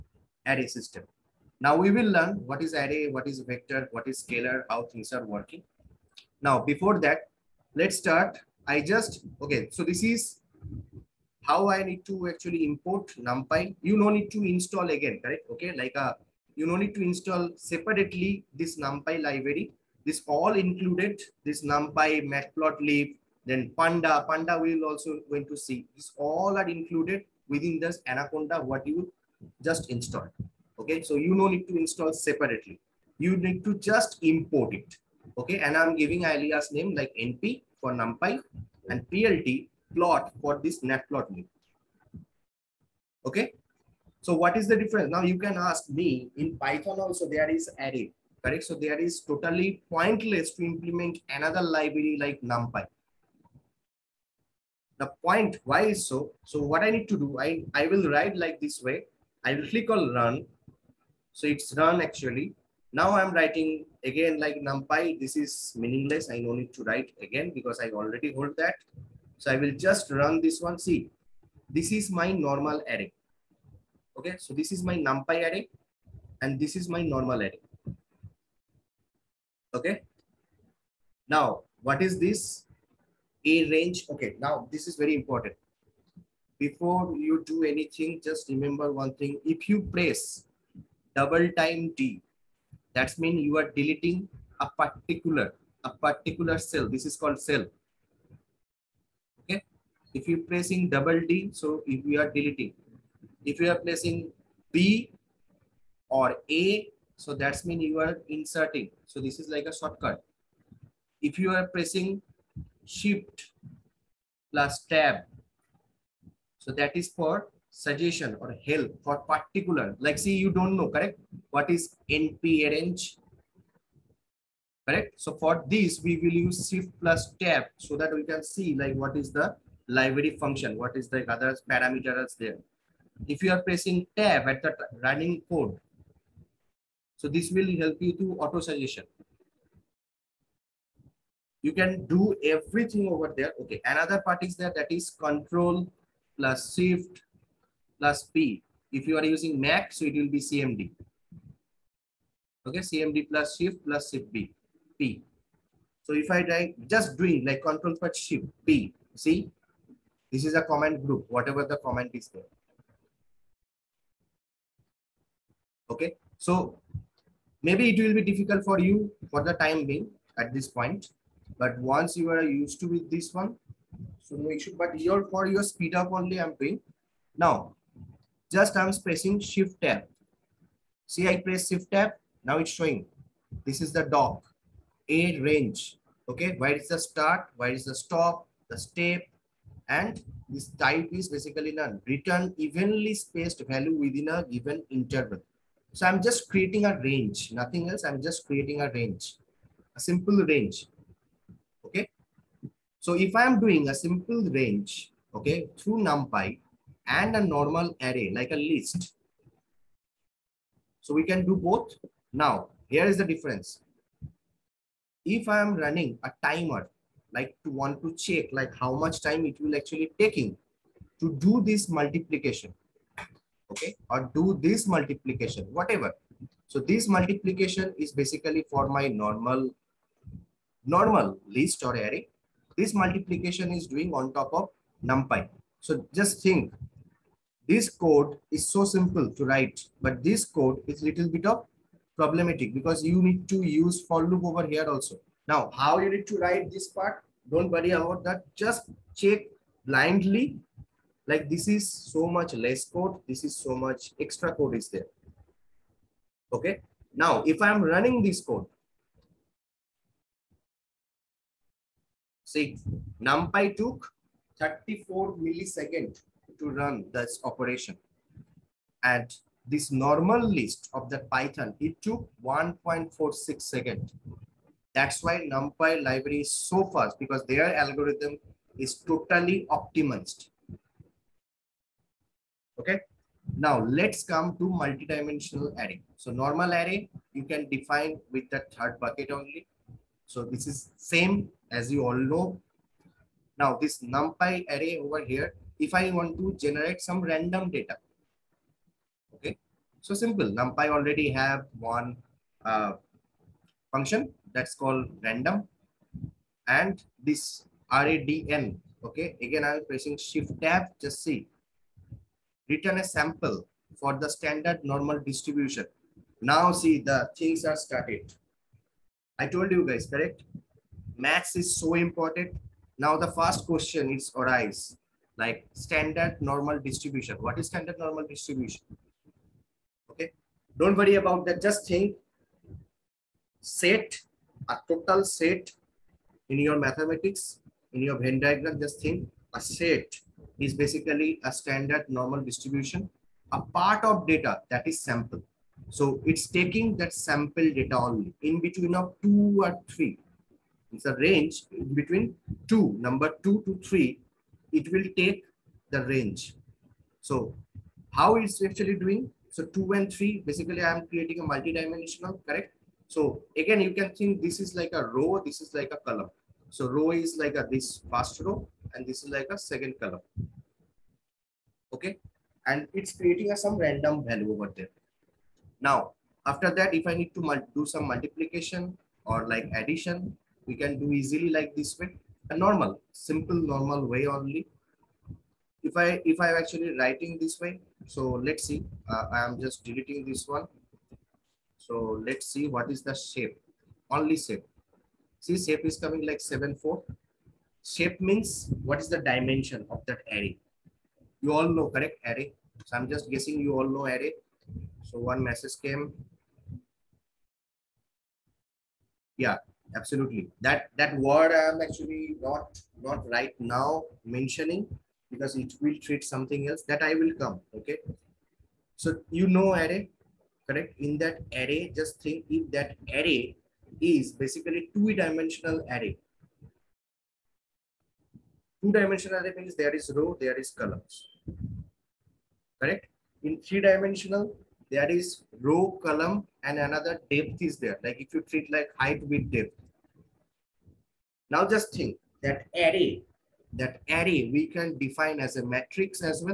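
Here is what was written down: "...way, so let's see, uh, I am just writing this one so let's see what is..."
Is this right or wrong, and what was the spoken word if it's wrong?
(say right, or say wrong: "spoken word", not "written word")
wrong: "deleting", not "writing".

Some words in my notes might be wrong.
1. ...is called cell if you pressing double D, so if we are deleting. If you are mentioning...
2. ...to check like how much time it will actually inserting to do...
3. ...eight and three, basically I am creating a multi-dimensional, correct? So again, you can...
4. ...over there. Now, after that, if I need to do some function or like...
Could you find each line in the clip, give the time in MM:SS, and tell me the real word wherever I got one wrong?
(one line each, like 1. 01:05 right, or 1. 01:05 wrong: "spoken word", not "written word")
1. 01:37 wrong: "pressing", not "mentioning"
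2. 03:38 wrong: "taking", not "inserting"
3. 05:59 wrong: "two", not "eight"
4. 06:14 wrong: "multiplication", not "function".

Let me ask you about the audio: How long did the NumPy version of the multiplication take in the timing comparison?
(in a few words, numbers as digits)
34 milliseconds.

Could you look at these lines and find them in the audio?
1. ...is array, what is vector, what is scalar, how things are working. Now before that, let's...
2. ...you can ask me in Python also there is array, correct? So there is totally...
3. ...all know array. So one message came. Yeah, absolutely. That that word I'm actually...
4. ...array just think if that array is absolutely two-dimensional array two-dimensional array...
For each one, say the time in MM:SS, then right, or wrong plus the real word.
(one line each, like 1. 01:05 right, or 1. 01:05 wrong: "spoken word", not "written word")
1. 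00:02 right
2. 00:45 right
3. 06:43 right
4. 07:01 wrong: "basically", not "absolutely".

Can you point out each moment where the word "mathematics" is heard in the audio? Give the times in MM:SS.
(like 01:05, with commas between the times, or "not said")
05:36.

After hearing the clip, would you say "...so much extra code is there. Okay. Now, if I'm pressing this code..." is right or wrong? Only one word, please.
wrong.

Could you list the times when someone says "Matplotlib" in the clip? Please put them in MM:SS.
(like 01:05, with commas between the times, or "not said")
00:22, 00:40.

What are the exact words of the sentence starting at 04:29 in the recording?
And this normal list of the Python, it took 1.46 seconds.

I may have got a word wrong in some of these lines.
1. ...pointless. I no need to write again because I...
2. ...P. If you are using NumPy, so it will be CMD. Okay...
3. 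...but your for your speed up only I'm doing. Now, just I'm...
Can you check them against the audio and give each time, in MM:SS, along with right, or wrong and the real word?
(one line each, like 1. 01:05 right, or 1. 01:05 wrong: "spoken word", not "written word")
1. 01:05 wrong: "meaningless", not "pointless"
2. 02:28 wrong: "Mac", not "NumPy"
3. 02:54 right.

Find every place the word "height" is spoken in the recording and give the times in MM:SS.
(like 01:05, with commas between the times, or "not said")
07:18.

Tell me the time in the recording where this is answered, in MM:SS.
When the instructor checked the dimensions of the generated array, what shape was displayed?
06:36.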